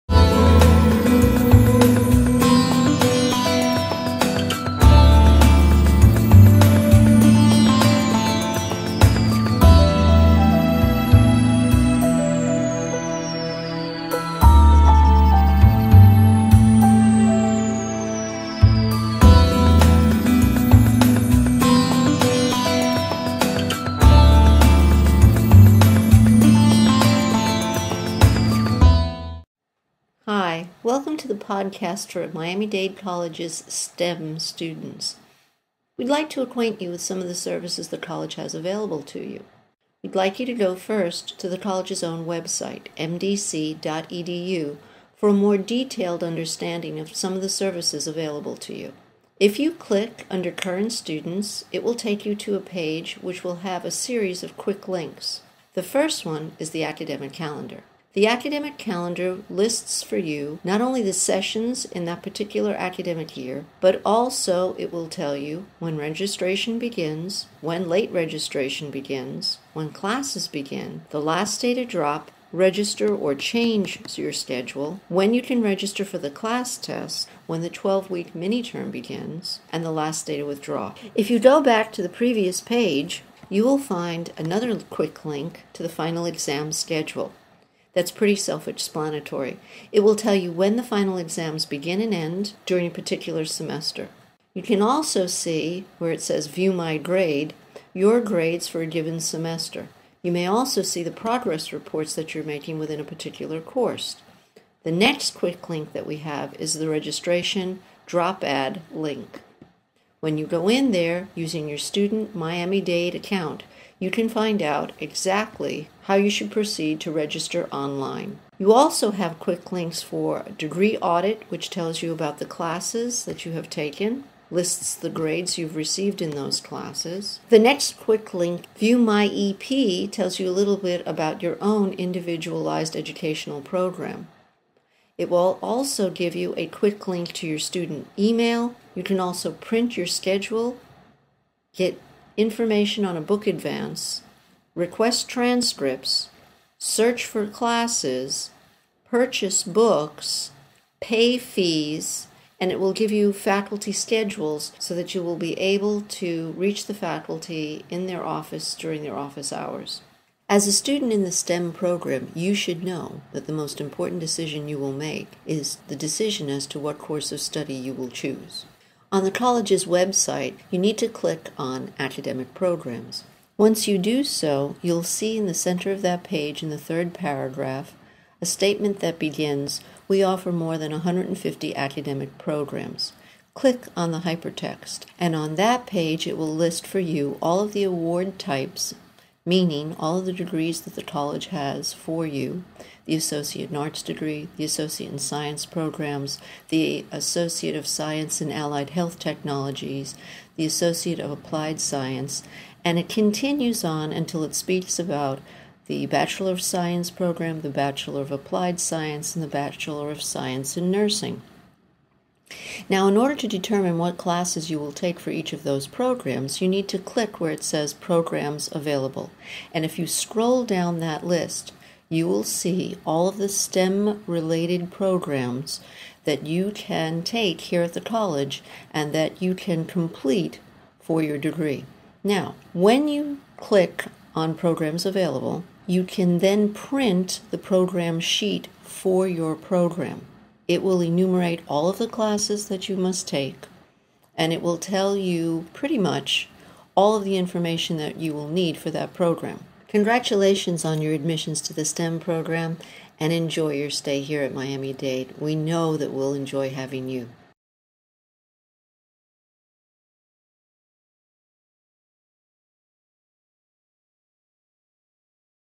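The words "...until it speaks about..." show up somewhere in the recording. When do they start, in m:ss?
3:24.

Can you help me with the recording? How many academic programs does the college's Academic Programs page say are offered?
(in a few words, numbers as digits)
more than 150.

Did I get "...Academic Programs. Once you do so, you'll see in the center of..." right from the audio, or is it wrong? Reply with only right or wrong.
right.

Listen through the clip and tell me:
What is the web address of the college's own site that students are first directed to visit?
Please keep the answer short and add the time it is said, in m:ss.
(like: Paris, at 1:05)
mdc.edu, at 0:42.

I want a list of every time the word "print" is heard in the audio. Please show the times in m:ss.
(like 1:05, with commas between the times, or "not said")
2:19, 3:56.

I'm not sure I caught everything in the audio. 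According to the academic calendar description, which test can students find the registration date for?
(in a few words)
CLAST.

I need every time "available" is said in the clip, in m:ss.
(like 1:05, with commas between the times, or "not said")
0:38, 0:48, 3:38, 3:55.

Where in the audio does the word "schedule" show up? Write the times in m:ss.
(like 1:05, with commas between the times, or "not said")
1:14, 1:26, 2:20, 2:33.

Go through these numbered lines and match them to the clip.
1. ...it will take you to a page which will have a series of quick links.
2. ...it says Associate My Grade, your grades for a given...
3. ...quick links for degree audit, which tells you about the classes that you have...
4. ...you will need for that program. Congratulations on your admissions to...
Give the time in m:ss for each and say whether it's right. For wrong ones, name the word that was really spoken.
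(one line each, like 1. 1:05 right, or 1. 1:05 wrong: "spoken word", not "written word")
1. 0:51 right
2. 1:36 wrong: "View", not "Associate"
3. 1:59 right
4. 4:08 right.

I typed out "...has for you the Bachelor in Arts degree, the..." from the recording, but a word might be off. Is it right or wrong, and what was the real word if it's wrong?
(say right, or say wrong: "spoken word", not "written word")
wrong: "Associate", not "Bachelor".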